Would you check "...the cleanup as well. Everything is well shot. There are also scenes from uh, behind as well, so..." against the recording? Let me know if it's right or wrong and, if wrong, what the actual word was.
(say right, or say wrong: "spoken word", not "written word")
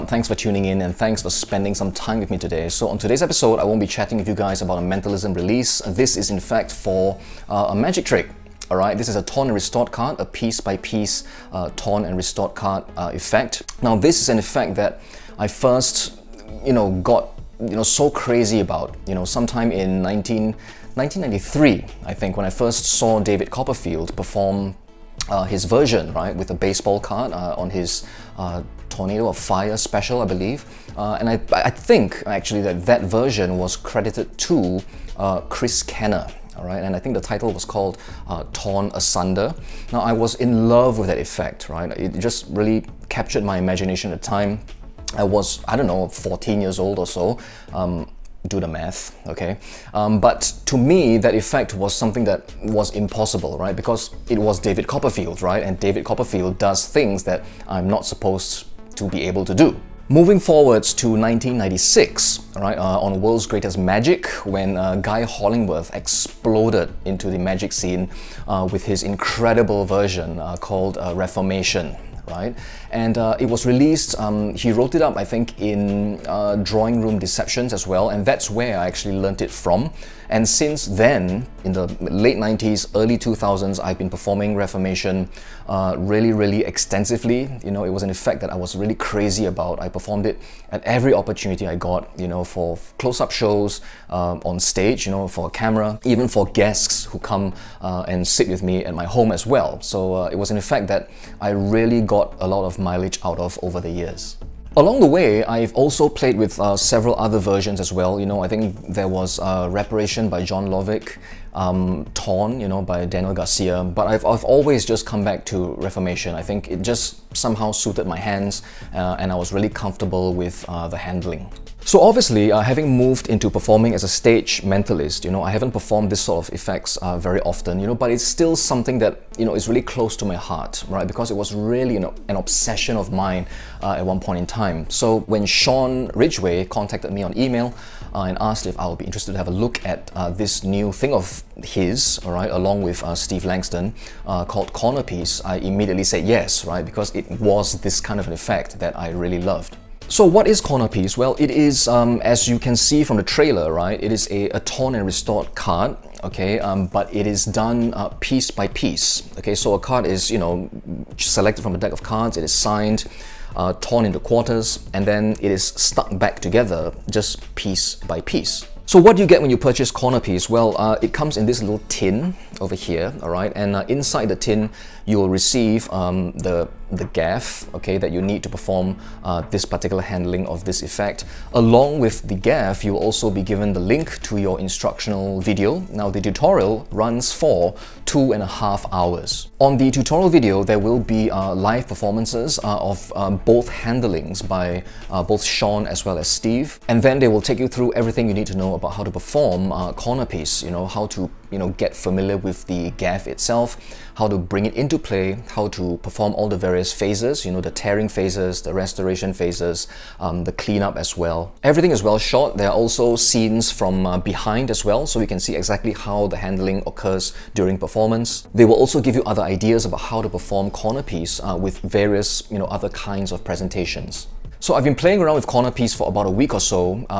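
right.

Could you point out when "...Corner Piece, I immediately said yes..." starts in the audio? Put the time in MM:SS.
02:24.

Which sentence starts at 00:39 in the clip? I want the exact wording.
Now, I was in love with that effect, right?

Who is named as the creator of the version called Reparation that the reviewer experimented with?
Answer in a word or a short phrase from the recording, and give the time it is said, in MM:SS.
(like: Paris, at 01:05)
John Lovick, at 01:50.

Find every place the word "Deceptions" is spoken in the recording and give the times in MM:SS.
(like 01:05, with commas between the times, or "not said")
01:17.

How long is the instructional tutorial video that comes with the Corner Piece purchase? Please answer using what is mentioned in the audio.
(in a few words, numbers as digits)
Two and a half hours.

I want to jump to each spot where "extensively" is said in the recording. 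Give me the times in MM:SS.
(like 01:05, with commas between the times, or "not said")
01:26.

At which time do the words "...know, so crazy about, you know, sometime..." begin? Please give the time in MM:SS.
00:17.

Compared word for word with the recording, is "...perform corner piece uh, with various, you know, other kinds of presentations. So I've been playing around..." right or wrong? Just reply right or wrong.
right.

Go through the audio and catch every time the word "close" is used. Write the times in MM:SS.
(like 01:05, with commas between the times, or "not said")
01:32, 02:09.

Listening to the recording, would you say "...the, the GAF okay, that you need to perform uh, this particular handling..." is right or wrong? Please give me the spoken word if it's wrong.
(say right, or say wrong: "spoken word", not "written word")
right.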